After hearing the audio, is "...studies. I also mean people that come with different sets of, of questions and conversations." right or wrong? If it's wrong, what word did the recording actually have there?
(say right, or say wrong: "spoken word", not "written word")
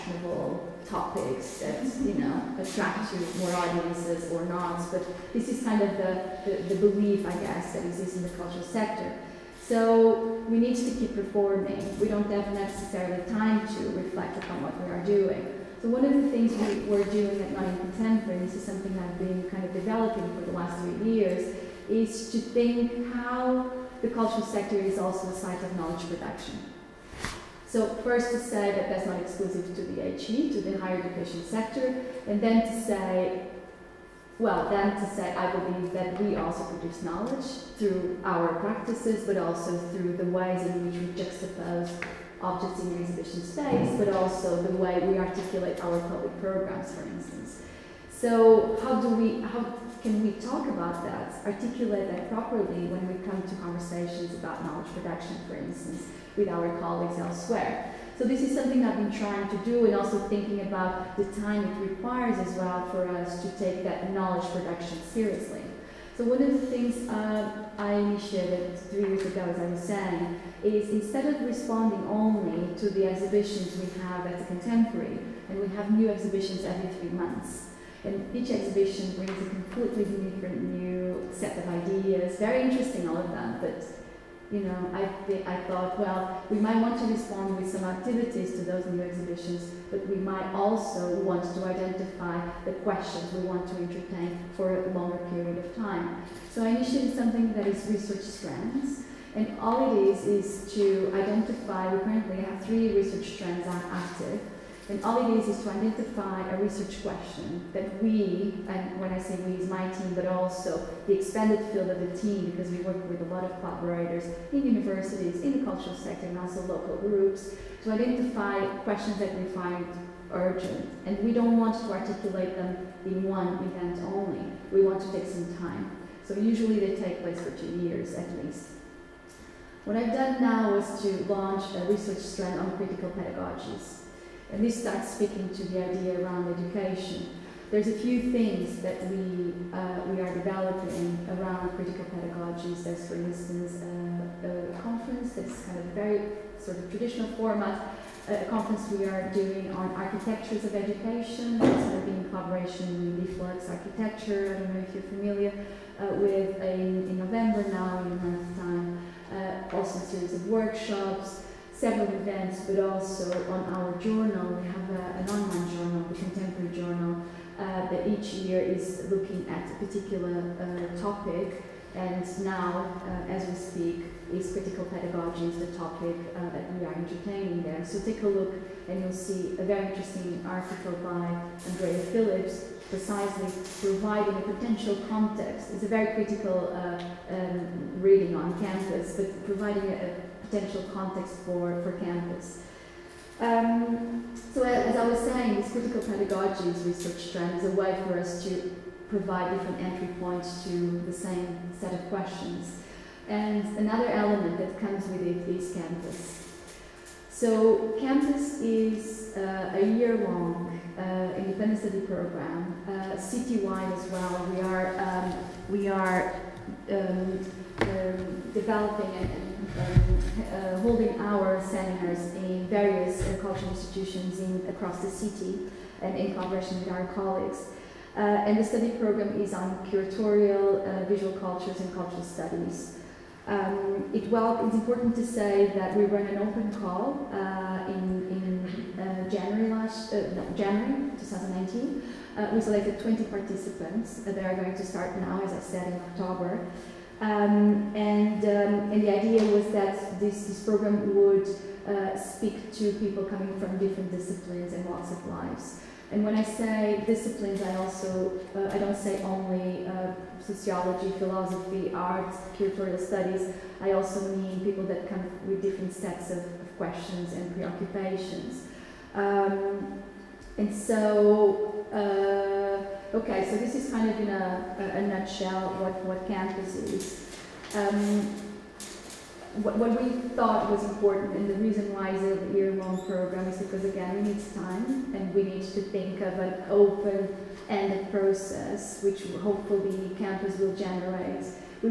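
wrong: "preoccupations", not "conversations".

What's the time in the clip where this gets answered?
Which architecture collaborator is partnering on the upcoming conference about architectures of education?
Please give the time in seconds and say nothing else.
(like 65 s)
153 s.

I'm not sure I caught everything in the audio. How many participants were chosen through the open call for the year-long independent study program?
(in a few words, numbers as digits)
20.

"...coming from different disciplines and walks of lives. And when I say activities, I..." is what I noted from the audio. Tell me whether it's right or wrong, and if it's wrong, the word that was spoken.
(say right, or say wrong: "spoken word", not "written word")
wrong: "disciplines", not "activities".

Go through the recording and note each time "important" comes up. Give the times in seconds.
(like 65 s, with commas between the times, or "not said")
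234 s, 280 s.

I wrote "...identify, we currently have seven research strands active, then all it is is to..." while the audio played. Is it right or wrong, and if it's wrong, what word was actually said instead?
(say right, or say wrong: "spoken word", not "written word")
wrong: "three", not "seven".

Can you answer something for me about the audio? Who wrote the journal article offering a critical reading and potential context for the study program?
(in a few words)
Andrea Phillips.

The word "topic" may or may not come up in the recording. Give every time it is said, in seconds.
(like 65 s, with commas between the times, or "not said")
0 s, 171 s, 175 s.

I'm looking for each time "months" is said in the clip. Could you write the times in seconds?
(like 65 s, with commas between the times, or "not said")
77 s, 158 s.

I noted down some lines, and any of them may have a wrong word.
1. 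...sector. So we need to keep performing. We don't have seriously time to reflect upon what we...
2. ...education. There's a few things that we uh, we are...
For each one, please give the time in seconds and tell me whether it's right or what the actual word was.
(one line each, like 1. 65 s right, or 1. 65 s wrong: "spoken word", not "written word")
1. 8 s wrong: "necessarily", not "seriously"
2. 136 s right.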